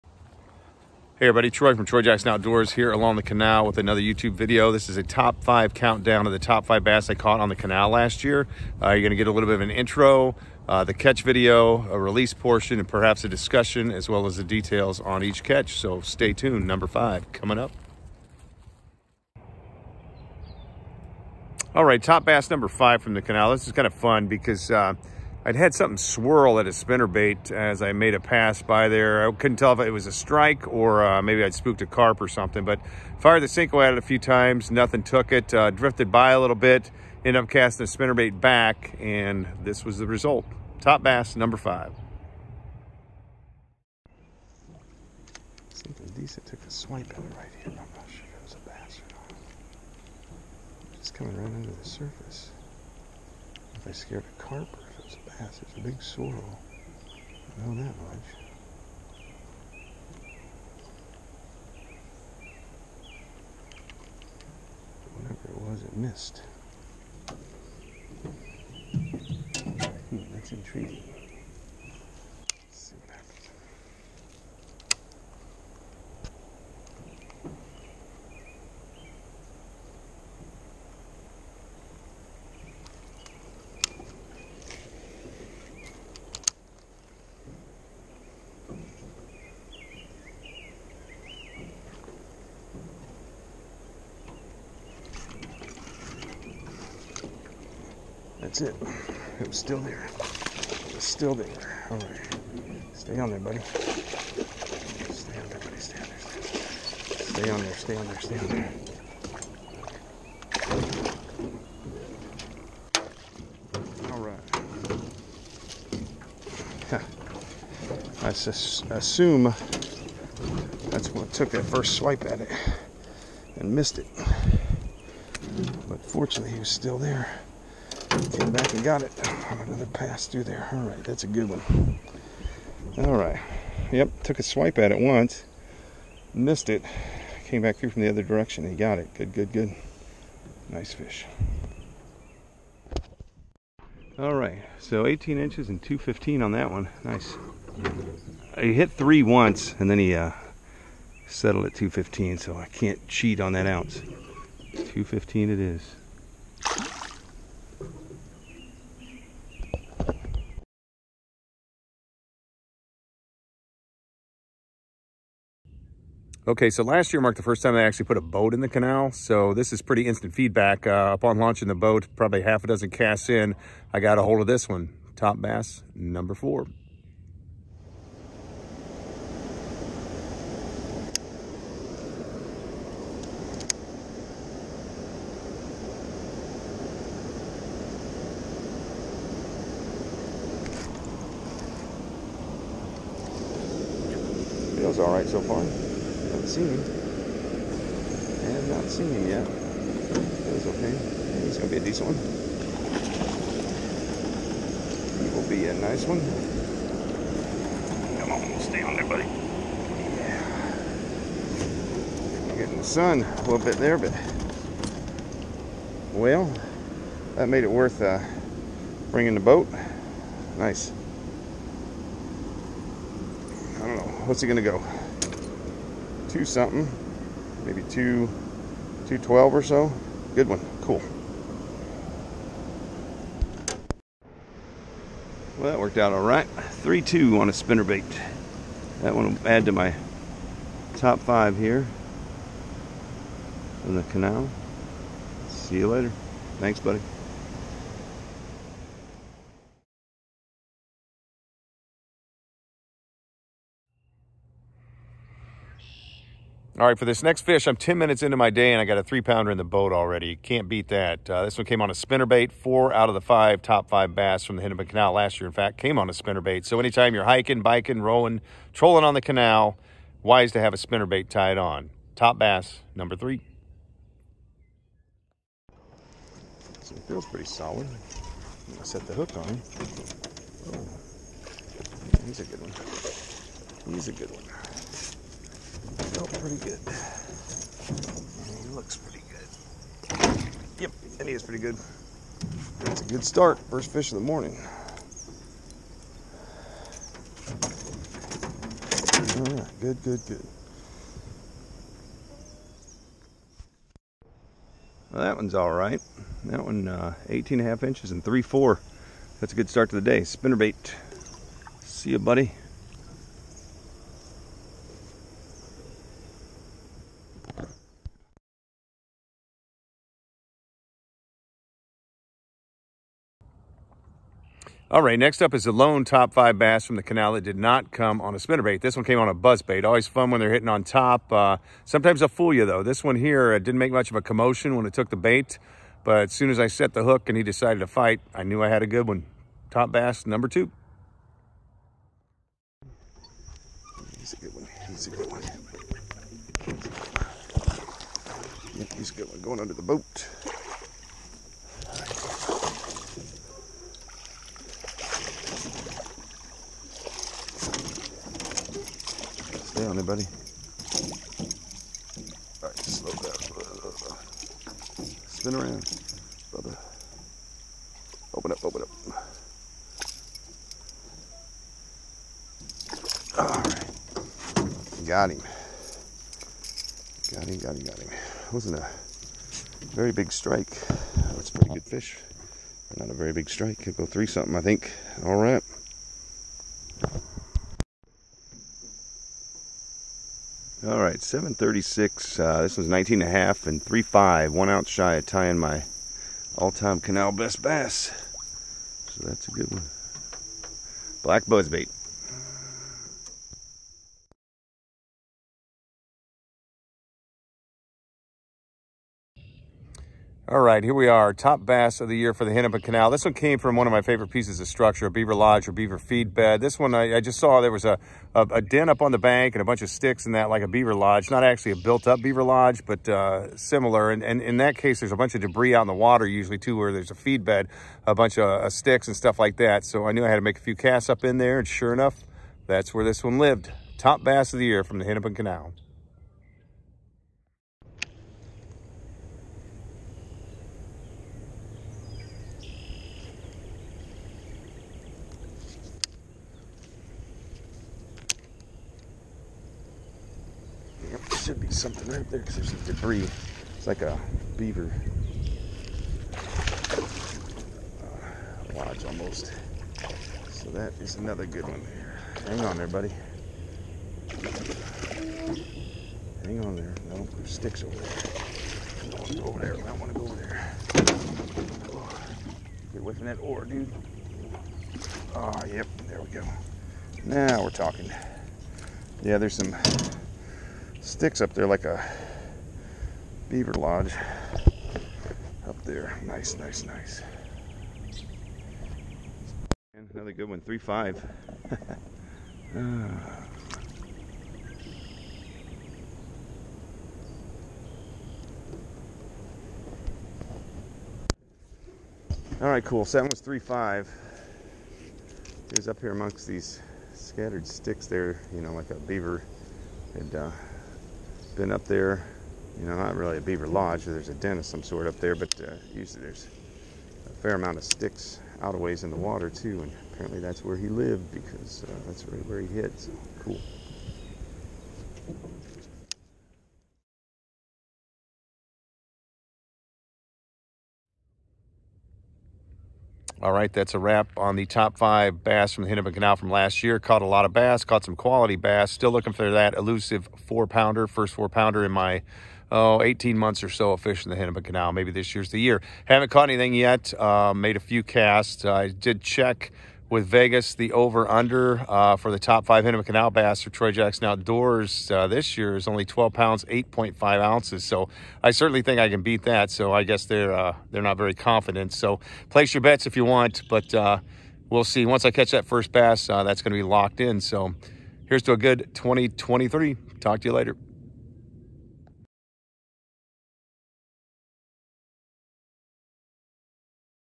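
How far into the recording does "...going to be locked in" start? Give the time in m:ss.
9:26.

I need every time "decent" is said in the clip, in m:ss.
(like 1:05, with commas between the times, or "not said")
0:46, 3:21.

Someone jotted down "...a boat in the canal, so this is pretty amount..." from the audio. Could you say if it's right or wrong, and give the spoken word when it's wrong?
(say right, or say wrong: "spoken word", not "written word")
wrong: "instant", not "amount".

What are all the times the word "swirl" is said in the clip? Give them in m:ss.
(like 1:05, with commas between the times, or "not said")
0:25.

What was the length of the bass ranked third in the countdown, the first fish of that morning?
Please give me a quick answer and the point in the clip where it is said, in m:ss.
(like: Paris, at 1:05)
18 and a half inches, at 5:07.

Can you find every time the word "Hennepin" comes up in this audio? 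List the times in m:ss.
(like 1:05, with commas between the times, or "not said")
4:24, 6:52, 7:15, 8:55, 9:04, 9:12.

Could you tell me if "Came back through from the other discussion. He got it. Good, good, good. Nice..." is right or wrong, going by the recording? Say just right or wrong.
wrong.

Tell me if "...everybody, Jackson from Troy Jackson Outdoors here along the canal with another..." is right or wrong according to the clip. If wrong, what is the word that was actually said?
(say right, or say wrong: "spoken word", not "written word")
wrong: "Troy", not "Jackson".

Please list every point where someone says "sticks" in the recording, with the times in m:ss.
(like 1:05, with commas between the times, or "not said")
6:59, 7:08, 7:47, 8:01, 8:27, 8:37.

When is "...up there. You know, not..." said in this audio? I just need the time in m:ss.
8:31.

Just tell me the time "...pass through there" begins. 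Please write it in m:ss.
2:09.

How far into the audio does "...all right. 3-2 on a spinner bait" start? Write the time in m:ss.
3:56.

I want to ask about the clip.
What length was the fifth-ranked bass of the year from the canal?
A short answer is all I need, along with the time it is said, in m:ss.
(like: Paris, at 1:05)
18 inches, at 2:25.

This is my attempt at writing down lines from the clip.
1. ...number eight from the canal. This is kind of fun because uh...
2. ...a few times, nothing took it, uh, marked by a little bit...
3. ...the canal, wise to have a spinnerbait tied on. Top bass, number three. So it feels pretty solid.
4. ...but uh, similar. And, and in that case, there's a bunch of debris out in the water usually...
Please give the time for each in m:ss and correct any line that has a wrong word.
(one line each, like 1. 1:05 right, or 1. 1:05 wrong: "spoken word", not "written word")
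1. 0:22 wrong: "five", not "eight"
2. 0:33 wrong: "drifted", not "marked"
3. 4:29 right
4. 7:02 right.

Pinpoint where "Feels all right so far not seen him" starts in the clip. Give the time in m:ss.
3:14.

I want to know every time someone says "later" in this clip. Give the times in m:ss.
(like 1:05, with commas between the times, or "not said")
4:05, 9:30.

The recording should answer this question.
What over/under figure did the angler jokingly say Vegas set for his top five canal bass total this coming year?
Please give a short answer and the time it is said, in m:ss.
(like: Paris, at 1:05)
12 pounds, 8.5 ounces, at 9:16.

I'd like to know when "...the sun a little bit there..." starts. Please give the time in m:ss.
3:32.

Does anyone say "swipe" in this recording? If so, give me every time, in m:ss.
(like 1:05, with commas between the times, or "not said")
0:46, 2:01, 2:14.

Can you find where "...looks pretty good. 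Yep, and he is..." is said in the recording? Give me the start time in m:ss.
4:48.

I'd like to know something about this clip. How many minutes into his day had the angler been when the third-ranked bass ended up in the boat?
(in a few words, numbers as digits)
10 minutes.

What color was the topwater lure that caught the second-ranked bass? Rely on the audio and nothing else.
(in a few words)
Black.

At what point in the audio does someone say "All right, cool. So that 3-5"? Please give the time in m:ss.
8:22.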